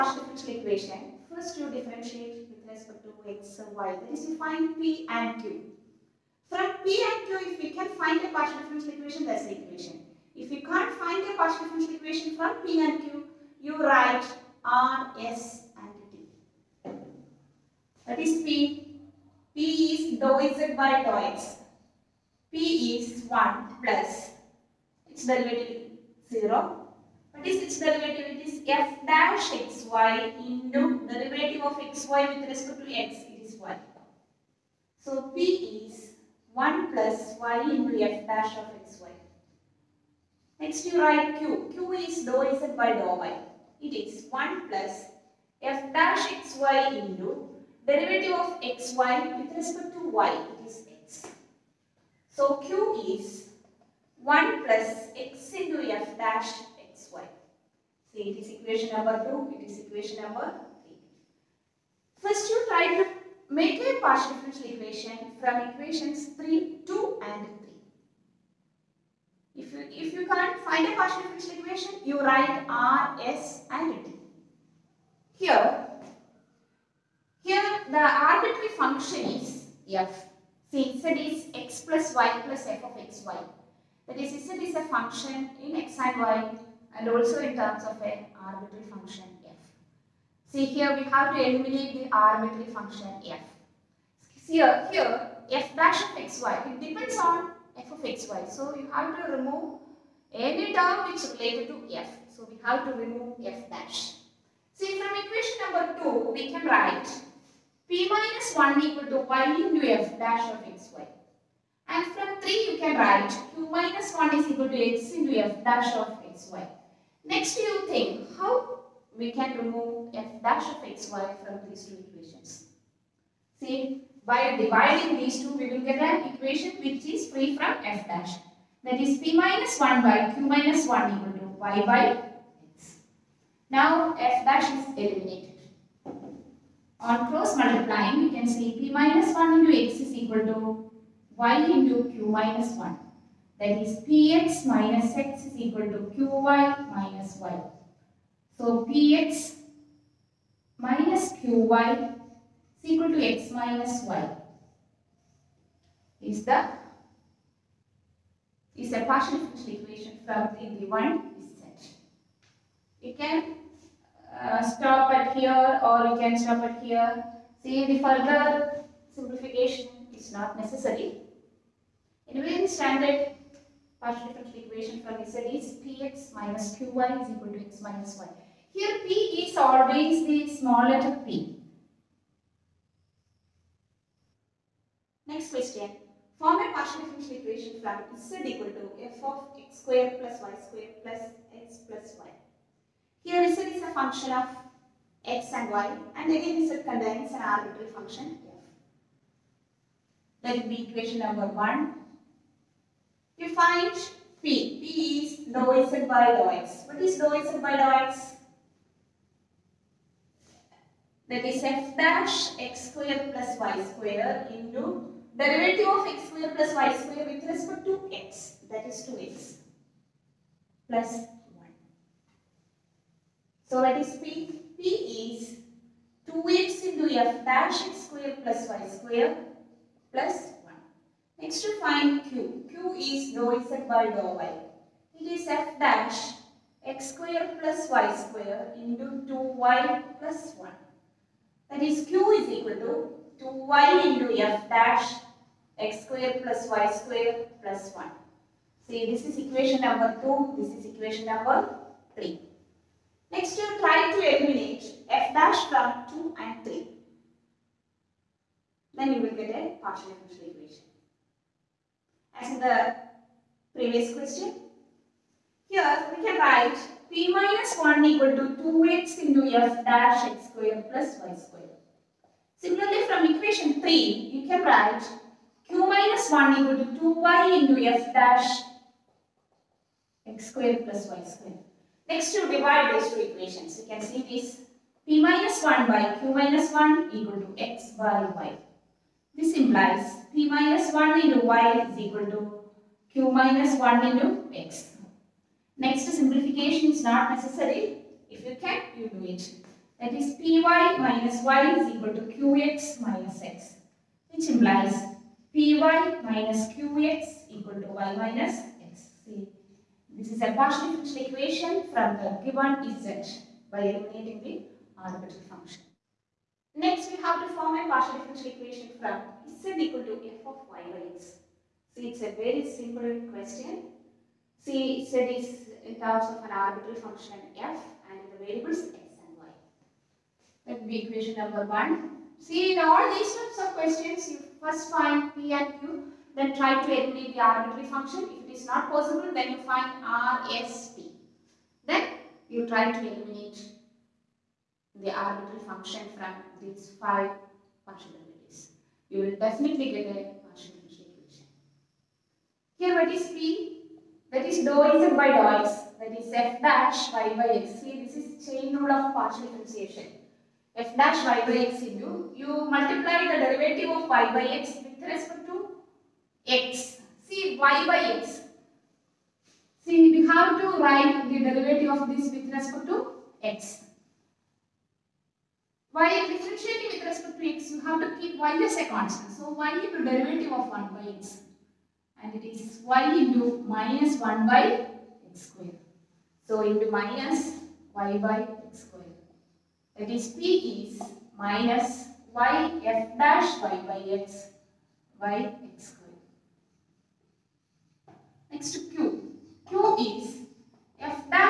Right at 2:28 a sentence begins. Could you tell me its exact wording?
So px minus qy is equal to x minus y is the is a partial differential equation felt in the one set.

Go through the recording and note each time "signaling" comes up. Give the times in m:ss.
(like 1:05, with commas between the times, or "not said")
not said.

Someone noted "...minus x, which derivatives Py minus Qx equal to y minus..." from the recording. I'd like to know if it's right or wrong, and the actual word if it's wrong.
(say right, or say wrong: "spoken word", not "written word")
wrong: "implies", not "derivatives".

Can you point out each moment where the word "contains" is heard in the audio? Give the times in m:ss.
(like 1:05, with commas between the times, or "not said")
3:16.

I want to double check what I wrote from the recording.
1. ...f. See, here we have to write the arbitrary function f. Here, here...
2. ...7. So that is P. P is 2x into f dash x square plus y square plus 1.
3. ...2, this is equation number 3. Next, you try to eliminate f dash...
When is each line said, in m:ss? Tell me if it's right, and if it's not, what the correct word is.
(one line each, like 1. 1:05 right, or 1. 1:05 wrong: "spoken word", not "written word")
1. 1:29 wrong: "eliminate", not "write"
2. 3:41 wrong: "1", not "7"
3. 4:10 right.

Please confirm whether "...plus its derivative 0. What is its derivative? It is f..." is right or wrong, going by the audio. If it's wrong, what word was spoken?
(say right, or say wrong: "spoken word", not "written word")
right.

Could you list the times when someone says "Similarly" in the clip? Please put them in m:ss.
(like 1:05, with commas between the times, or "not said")
4:32.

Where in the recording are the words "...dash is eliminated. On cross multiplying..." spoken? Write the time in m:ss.
2:14.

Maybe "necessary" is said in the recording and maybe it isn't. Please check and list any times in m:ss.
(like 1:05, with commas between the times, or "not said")
2:50, 4:57.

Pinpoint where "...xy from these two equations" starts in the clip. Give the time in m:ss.
2:00.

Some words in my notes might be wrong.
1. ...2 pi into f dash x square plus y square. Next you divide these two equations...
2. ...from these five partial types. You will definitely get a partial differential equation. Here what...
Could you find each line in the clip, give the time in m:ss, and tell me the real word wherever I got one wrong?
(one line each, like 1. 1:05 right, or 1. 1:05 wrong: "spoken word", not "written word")
1. 4:36 right
2. 5:46 wrong: "derivatives", not "types".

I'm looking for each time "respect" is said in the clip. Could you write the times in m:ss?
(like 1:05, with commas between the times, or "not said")
0:02, 0:32, 0:49, 3:37, 6:05, 6:12, 6:17.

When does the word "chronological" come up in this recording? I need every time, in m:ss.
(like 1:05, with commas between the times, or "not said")
not said.